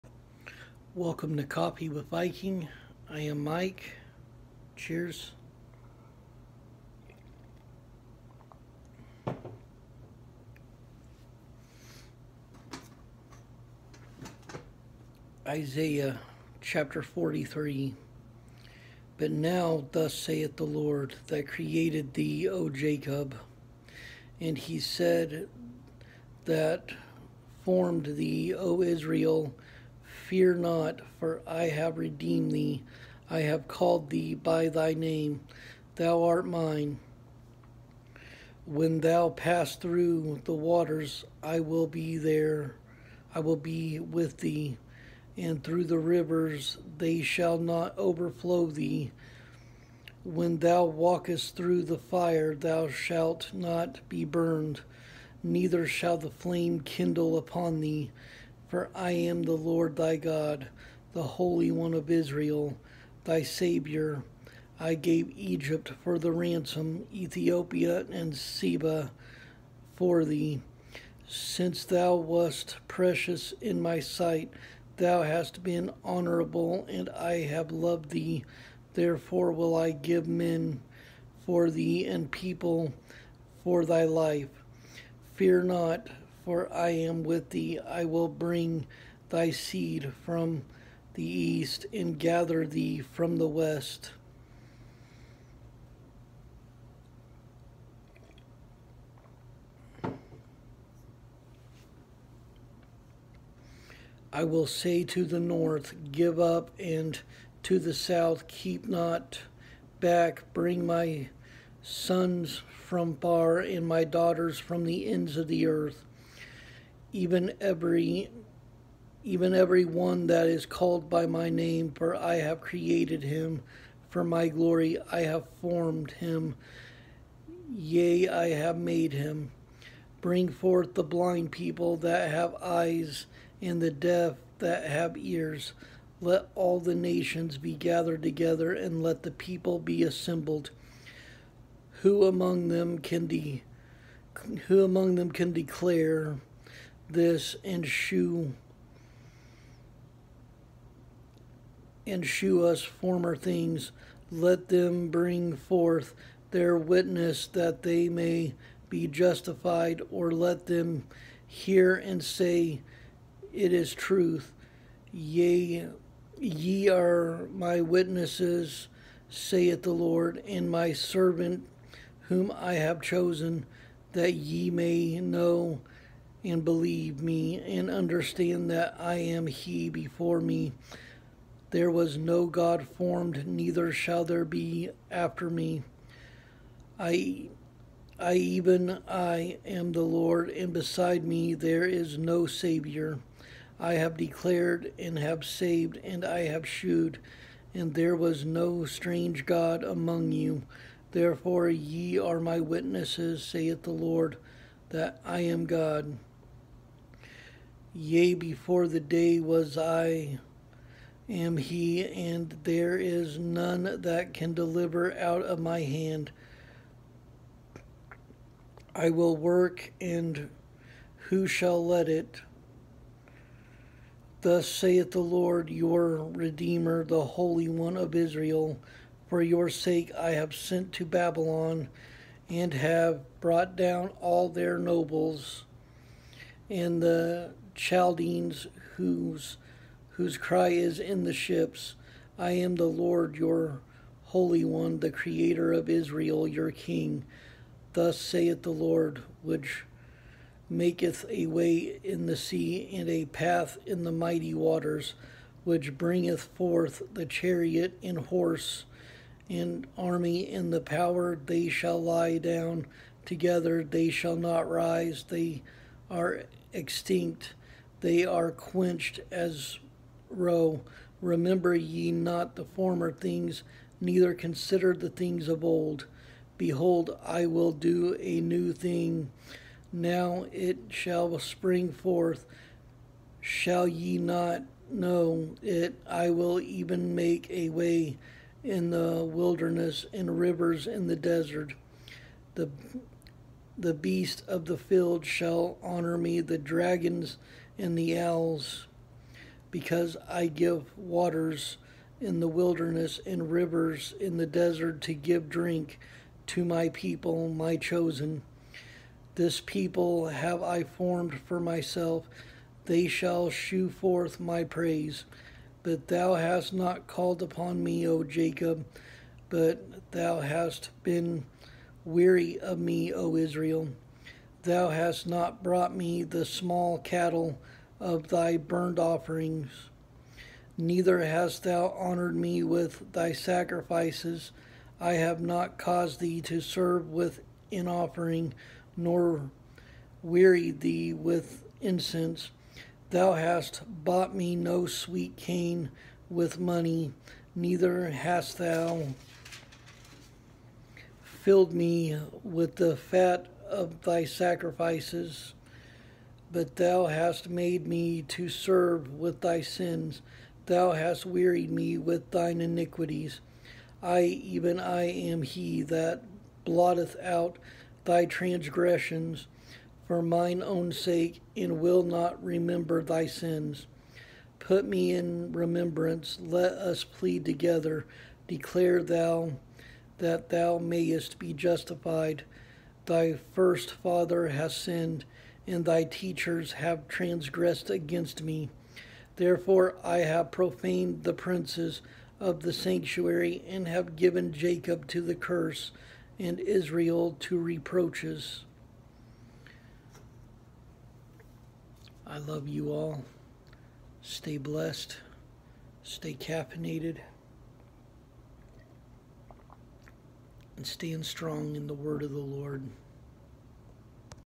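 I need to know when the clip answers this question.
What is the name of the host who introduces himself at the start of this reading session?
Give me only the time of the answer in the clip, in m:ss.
0:03.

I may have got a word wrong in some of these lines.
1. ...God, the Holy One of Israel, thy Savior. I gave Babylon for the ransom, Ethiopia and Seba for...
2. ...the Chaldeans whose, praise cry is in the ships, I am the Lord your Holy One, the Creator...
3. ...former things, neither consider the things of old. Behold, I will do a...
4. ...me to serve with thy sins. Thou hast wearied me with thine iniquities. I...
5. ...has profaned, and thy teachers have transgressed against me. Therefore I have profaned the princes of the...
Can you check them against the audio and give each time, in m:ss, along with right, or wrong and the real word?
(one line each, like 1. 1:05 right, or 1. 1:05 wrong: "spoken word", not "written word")
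1. 1:00 wrong: "Egypt", not "Babylon"
2. 3:57 wrong: "whose", not "praise"
3. 4:32 right
4. 5:57 right
5. 6:24 wrong: "sinned", not "profaned".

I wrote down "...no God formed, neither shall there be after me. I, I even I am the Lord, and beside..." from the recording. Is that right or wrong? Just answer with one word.
right.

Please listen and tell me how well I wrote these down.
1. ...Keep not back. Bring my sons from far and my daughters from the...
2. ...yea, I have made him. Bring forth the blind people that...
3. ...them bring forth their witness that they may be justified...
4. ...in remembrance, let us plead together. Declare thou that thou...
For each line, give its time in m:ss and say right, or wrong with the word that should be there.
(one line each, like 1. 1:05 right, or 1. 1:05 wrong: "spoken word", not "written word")
1. 1:48 right
2. 2:07 right
3. 2:34 right
4. 6:15 right.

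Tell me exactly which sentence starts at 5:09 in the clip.
This people have I formed for myself, they shall shew forth my praise.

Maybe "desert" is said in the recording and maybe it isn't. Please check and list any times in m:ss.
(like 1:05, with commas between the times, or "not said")
4:51, 5:04.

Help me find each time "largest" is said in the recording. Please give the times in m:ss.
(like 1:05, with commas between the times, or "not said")
not said.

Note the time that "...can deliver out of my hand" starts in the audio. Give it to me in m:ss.
3:34.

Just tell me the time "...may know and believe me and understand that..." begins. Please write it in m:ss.
2:54.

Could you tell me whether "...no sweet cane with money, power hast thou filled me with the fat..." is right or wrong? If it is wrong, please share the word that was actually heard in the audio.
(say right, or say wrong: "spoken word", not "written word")
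wrong: "neither", not "power".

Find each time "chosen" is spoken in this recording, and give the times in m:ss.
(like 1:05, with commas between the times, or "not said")
2:53, 5:07.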